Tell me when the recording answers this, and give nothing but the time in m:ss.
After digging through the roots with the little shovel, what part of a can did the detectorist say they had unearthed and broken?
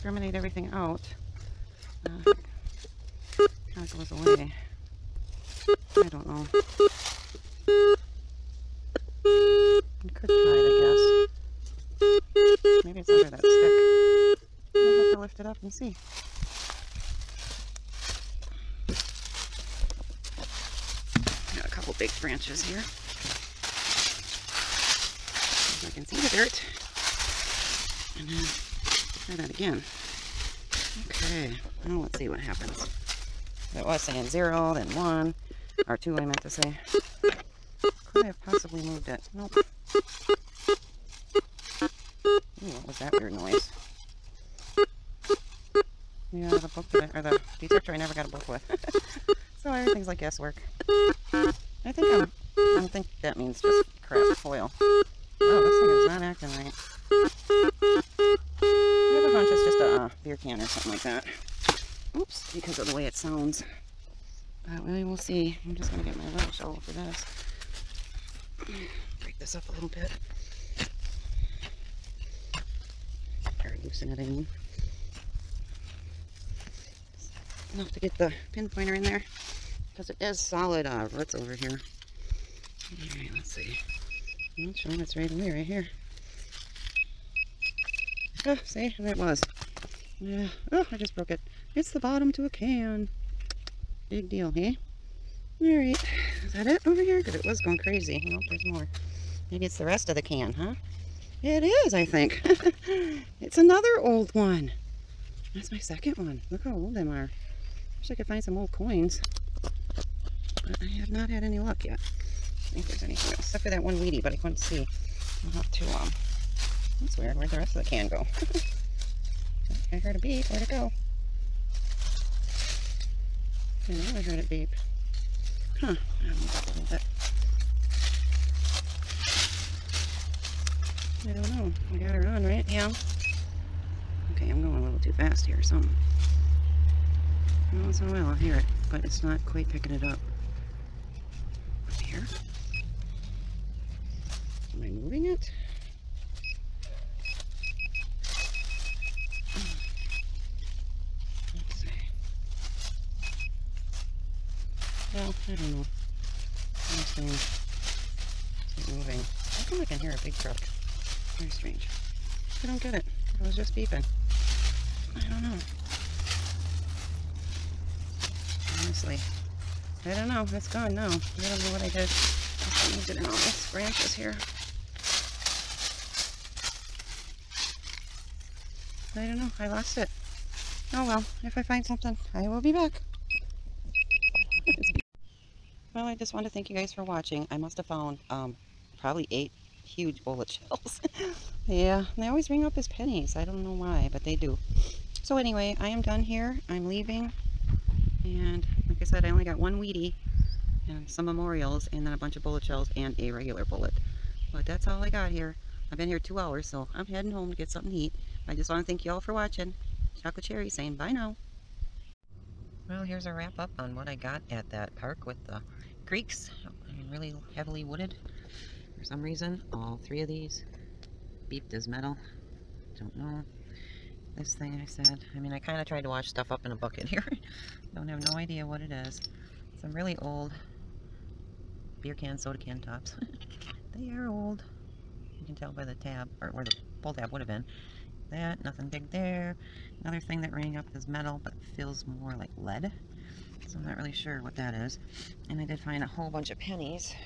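1:31.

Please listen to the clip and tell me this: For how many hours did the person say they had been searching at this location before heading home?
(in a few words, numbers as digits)
2.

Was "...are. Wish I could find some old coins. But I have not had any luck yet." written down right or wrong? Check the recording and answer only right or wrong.
right.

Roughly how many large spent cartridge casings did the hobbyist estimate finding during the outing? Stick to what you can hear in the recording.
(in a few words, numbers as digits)
8.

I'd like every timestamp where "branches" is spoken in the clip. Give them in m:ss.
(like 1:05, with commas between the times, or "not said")
0:22, 2:53.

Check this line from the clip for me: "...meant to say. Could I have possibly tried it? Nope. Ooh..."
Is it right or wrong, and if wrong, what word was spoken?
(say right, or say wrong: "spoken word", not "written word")
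wrong: "moved", not "tried".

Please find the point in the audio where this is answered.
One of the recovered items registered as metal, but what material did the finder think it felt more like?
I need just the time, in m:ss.
4:02.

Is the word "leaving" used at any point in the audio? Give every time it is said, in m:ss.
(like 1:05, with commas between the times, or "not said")
3:16.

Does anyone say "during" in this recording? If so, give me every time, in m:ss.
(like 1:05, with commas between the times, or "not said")
not said.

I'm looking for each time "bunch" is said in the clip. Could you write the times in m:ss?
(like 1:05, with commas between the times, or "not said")
0:59, 3:22, 4:06.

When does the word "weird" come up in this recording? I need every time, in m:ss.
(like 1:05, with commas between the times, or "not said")
0:43, 1:57.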